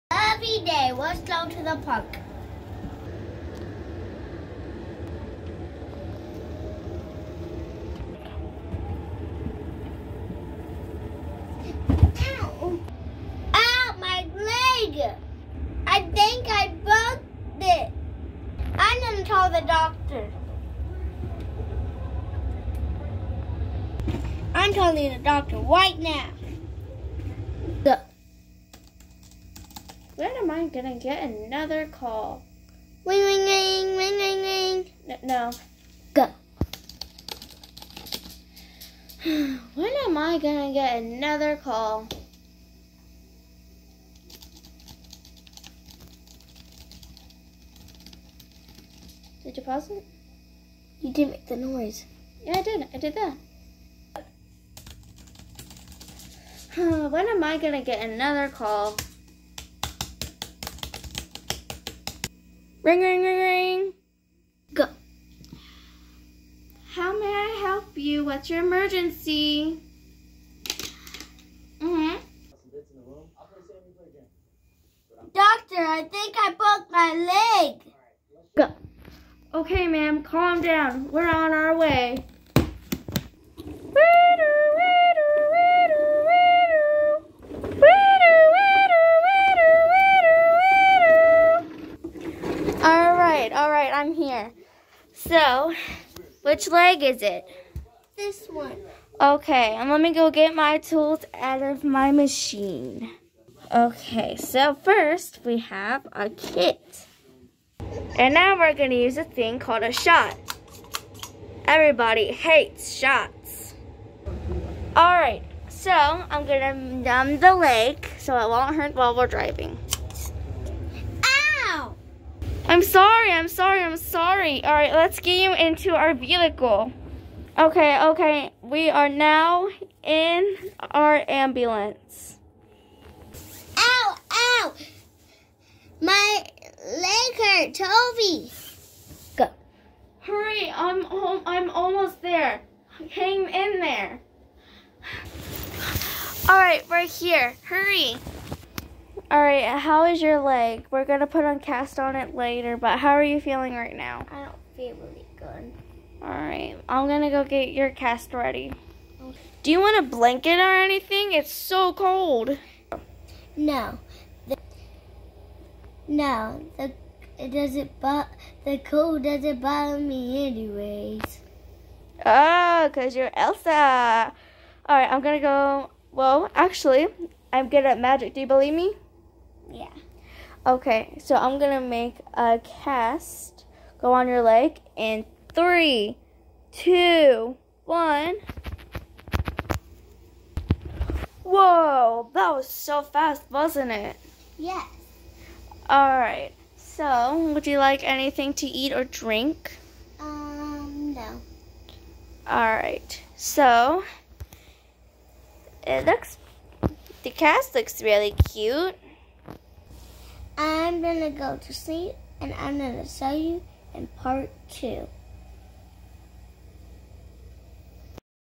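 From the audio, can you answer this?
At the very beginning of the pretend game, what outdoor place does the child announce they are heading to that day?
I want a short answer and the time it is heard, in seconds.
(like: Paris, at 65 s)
the park, at 1 s.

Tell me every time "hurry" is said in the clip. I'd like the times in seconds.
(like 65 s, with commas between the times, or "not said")
140 s, 147 s.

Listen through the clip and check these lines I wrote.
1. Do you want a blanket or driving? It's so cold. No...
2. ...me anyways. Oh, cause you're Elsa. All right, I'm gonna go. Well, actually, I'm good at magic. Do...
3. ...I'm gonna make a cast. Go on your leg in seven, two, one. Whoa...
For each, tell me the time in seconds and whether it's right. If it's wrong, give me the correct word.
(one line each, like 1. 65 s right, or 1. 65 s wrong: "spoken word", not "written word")
1. 159 s wrong: "anything", not "driving"
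2. 169 s right
3. 181 s wrong: "three", not "seven".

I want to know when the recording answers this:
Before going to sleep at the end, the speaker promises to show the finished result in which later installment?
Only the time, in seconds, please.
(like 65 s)
214 s.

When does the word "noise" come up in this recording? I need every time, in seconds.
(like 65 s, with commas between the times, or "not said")
51 s.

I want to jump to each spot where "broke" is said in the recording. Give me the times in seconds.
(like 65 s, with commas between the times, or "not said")
16 s, 76 s.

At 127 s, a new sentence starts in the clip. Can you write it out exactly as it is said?
Okay, okay, we are now in our ambulance.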